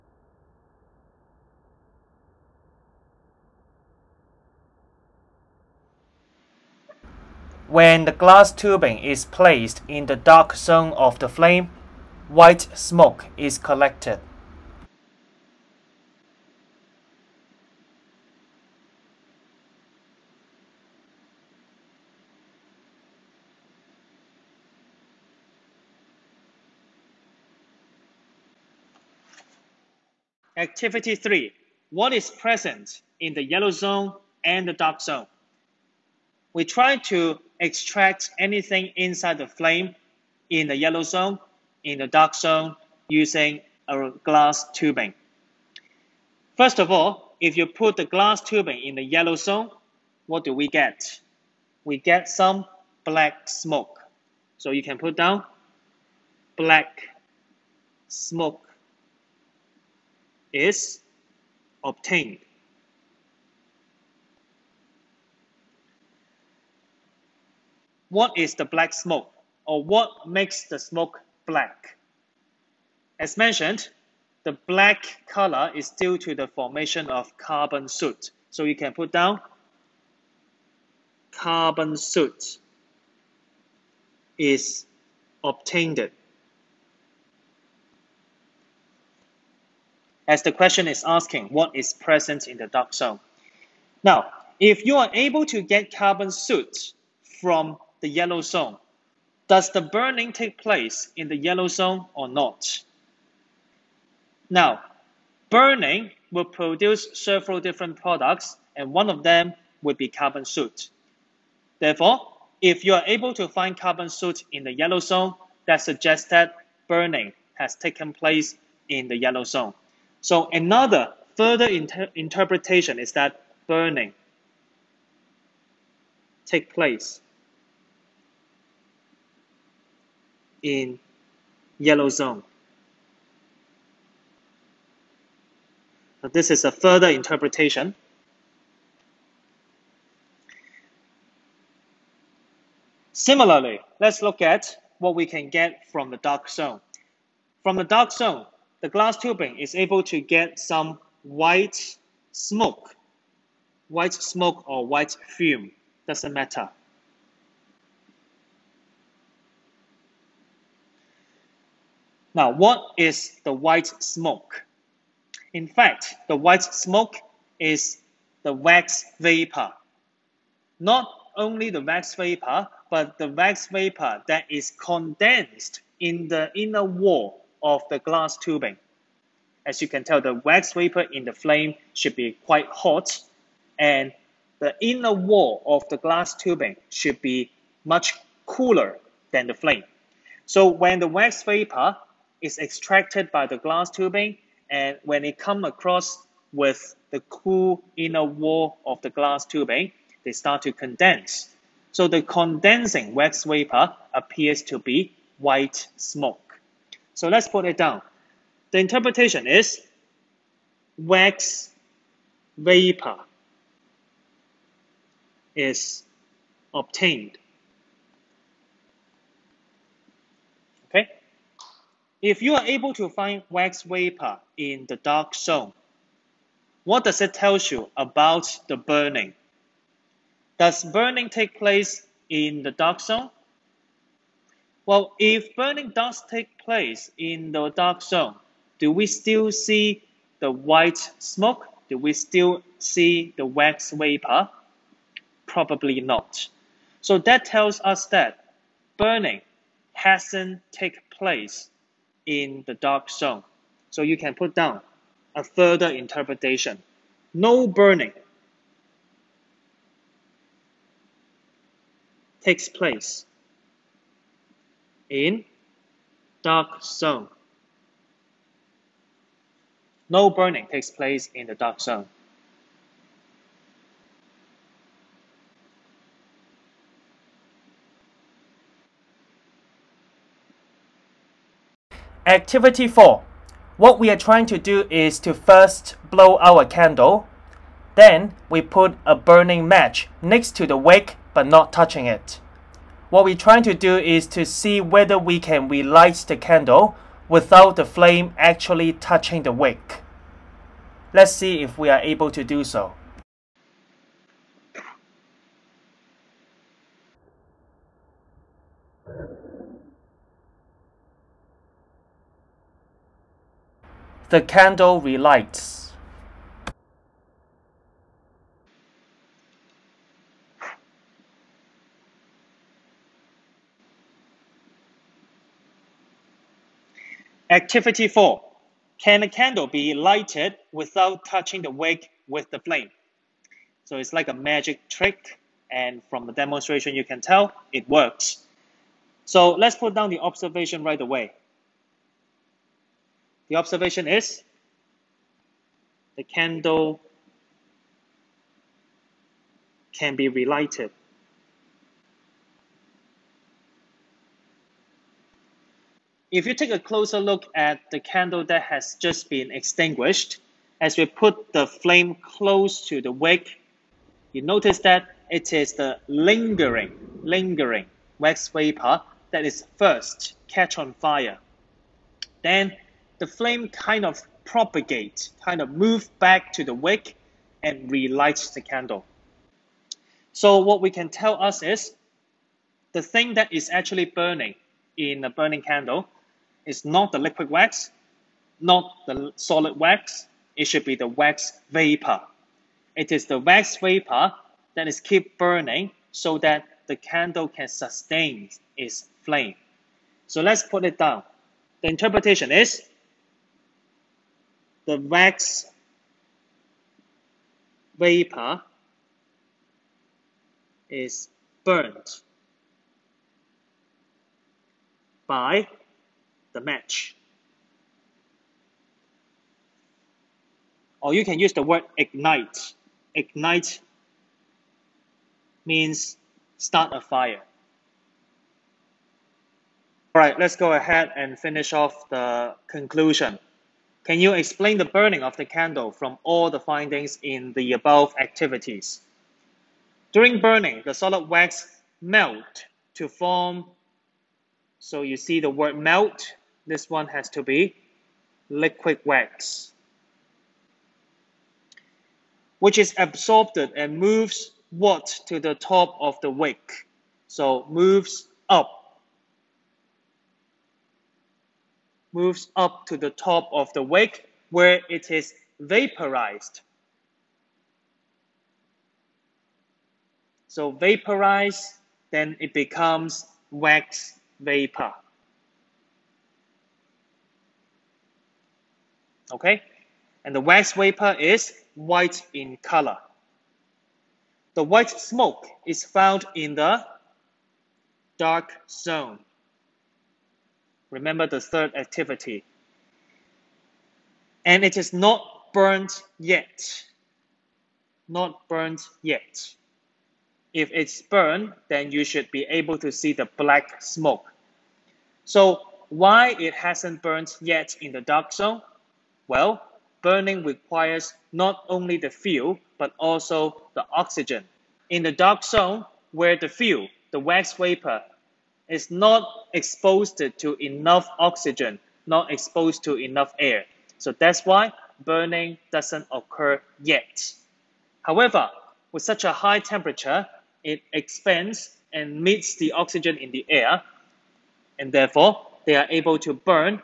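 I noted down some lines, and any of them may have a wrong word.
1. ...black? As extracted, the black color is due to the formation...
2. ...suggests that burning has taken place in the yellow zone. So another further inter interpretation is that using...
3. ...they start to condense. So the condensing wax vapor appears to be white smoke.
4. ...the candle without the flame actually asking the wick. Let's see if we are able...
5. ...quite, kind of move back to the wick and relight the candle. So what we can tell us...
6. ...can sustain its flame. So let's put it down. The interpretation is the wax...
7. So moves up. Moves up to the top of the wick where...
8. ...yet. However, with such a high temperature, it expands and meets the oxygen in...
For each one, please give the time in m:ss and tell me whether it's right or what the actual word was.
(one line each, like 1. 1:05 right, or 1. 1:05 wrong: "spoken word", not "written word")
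1. 1:11 wrong: "mentioned", not "extracted"
2. 1:55 wrong: "burning", not "using"
3. 3:20 right
4. 4:56 wrong: "touching", not "asking"
5. 6:14 wrong: "propagate", not "quite"
6. 6:37 right
7. 7:37 right
8. 8:46 right.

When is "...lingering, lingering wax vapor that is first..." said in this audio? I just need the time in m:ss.
6:06.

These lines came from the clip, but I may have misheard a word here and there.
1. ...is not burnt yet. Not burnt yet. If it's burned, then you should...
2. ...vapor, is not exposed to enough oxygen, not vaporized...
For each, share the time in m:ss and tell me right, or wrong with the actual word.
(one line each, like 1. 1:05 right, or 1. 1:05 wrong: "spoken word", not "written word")
1. 8:14 right
2. 8:37 wrong: "exposed", not "vaporized".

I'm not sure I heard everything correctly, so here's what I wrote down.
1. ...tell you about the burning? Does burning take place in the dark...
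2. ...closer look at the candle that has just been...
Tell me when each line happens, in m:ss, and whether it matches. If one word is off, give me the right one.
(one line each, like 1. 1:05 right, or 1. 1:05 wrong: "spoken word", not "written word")
1. 3:47 right
2. 5:56 right.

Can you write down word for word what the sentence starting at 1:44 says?
Now, burning will produce several different products, and one of them would be carbon soot.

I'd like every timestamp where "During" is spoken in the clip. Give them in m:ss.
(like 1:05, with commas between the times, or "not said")
7:20.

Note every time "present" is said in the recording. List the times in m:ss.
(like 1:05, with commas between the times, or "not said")
0:32, 1:31.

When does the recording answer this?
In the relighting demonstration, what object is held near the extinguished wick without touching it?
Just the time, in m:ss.
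4:49.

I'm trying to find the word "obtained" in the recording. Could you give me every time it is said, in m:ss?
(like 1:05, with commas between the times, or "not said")
1:01, 1:25, 3:36.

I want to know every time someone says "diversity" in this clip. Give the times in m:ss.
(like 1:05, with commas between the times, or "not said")
not said.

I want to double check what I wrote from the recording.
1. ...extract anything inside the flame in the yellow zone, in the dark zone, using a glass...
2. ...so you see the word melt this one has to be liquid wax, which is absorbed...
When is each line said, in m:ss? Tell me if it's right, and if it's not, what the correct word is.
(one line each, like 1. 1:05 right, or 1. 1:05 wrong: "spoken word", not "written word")
1. 0:37 right
2. 7:24 right.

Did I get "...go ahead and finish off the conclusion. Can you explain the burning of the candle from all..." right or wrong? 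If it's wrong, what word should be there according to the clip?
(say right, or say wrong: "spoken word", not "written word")
right.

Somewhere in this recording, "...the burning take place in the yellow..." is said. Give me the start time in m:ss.
1:39.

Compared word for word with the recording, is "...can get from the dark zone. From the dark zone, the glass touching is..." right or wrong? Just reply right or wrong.
wrong.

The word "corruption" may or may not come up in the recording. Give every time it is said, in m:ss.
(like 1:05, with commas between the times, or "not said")
not said.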